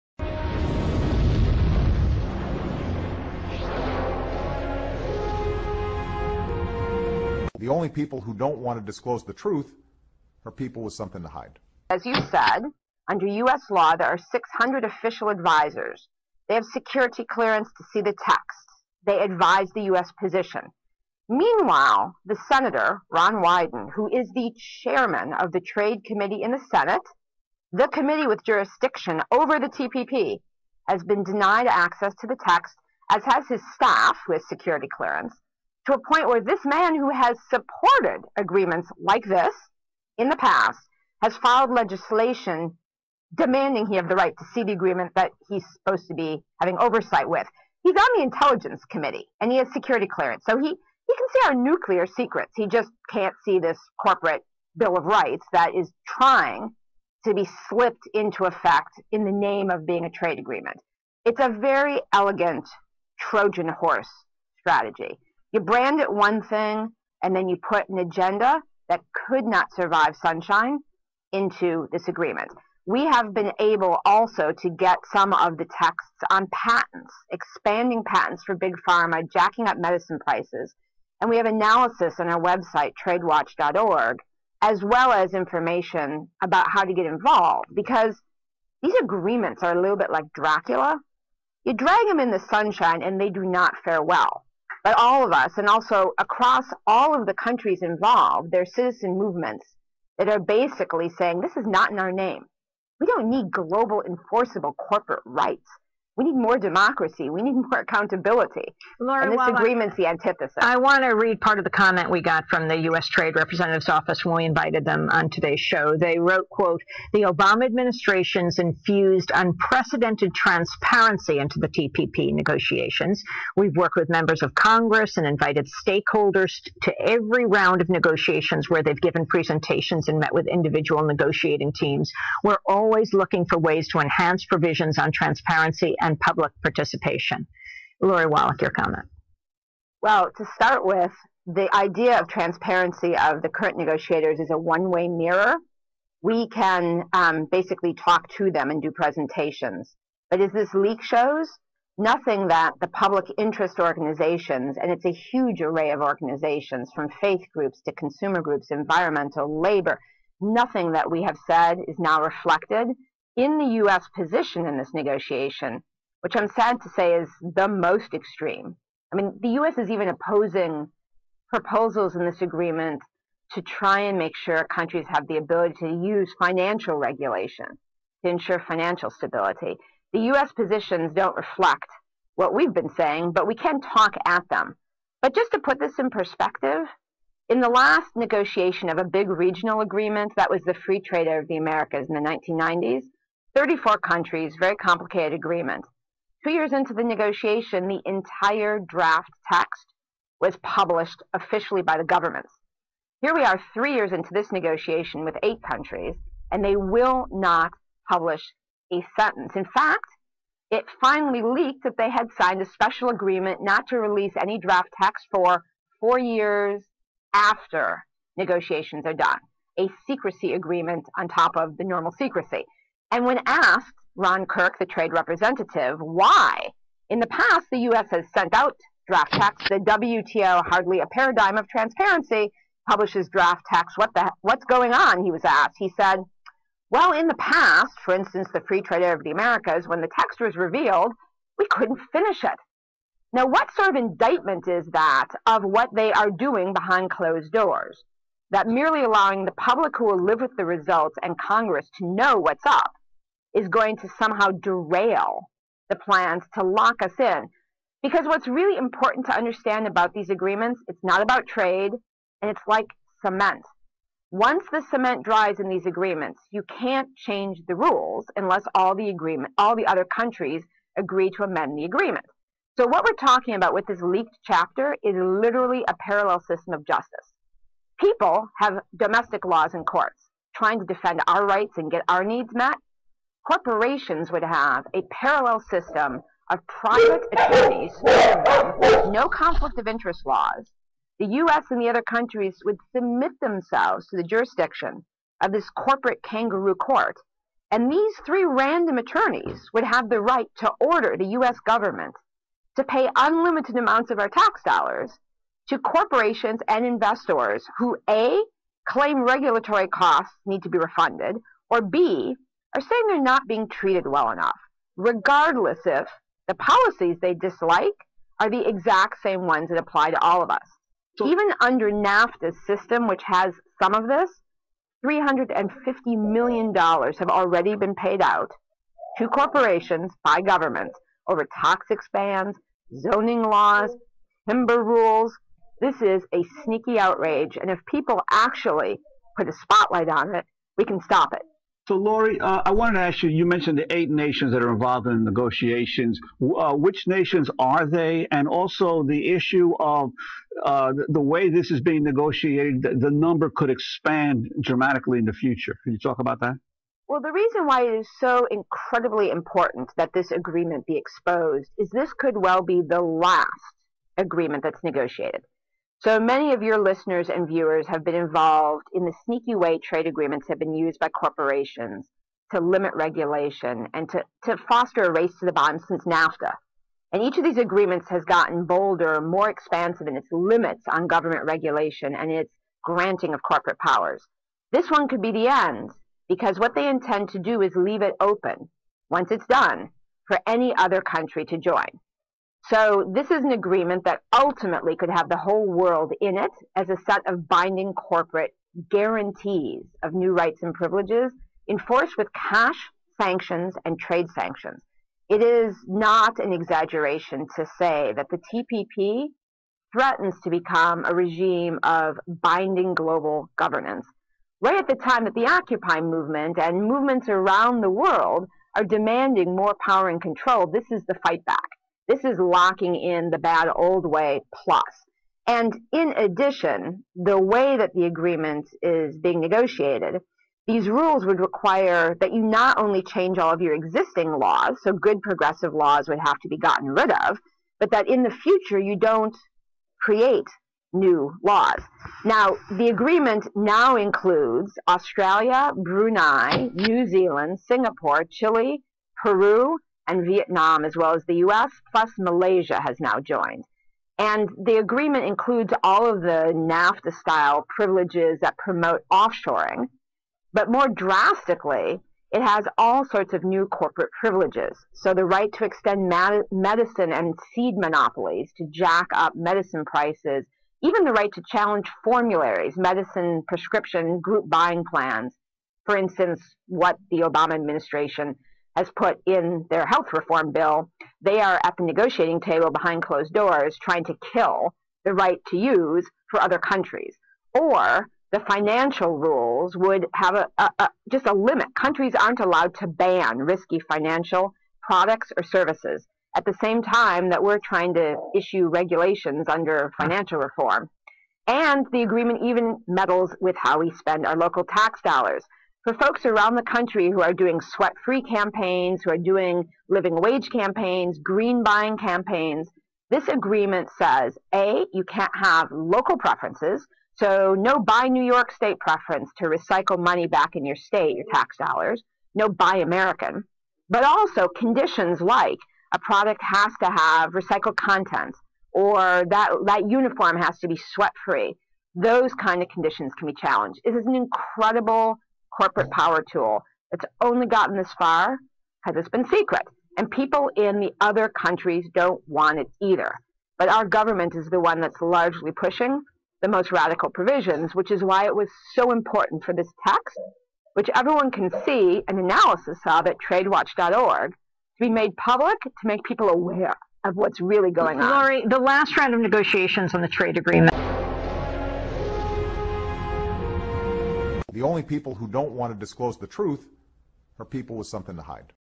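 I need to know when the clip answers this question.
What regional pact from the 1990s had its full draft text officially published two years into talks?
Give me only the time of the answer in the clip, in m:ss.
3:10.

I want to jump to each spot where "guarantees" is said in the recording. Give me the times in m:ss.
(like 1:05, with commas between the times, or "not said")
6:38.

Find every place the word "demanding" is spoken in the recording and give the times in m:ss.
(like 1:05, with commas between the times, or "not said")
0:43, 6:58.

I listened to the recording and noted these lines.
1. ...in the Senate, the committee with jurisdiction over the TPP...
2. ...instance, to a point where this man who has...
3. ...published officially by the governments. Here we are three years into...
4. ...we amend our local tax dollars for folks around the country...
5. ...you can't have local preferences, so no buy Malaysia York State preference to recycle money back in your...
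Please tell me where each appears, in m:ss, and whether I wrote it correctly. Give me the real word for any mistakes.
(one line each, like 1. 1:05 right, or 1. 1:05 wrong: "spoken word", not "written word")
1. 0:26 right
2. 0:34 wrong: "clearance", not "instance"
3. 3:20 right
4. 8:23 wrong: "spend", not "amend"
5. 8:34 wrong: "New", not "Malaysia".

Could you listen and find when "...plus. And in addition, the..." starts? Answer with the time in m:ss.
7:04.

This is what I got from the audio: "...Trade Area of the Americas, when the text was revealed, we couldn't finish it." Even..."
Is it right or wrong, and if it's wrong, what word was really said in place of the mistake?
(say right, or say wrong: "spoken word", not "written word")
wrong: "Now", not "Even".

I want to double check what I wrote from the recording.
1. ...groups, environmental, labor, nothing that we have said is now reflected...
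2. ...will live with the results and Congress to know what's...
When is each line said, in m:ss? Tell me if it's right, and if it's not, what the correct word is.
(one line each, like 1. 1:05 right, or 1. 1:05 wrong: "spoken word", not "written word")
1. 2:38 right
2. 4:10 right.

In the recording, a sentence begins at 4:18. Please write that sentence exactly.
Because what's really important to understand about these agreements, it's not about trade and it's like cement.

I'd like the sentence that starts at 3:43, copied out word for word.
And when asked Ron Kirk, the trade representative, why in the past the U.S.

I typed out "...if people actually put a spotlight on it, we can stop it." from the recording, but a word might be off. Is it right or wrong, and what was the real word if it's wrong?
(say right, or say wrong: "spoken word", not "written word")
right.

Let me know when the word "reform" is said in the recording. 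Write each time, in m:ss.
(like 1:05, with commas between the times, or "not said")
8:00, 8:20.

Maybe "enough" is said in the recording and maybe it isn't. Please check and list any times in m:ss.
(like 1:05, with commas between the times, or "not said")
5:14.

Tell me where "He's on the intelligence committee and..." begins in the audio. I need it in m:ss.
0:47.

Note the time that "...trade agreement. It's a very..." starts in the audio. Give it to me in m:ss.
1:00.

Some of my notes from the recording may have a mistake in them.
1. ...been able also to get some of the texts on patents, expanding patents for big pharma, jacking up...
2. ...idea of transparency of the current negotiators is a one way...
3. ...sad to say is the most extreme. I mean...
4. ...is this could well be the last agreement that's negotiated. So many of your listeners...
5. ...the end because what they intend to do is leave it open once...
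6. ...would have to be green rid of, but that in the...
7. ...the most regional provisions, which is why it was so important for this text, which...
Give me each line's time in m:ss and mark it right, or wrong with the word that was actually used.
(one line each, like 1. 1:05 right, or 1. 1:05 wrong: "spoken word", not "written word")
1. 1:13 right
2. 2:21 right
3. 2:46 right
4. 6:01 right
5. 6:25 right
6. 7:16 wrong: "gotten", not "green"
7. 9:06 wrong: "radical", not "regional".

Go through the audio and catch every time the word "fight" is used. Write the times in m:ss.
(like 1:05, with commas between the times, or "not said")
7:01.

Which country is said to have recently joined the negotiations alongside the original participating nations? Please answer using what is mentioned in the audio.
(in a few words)
Malaysia.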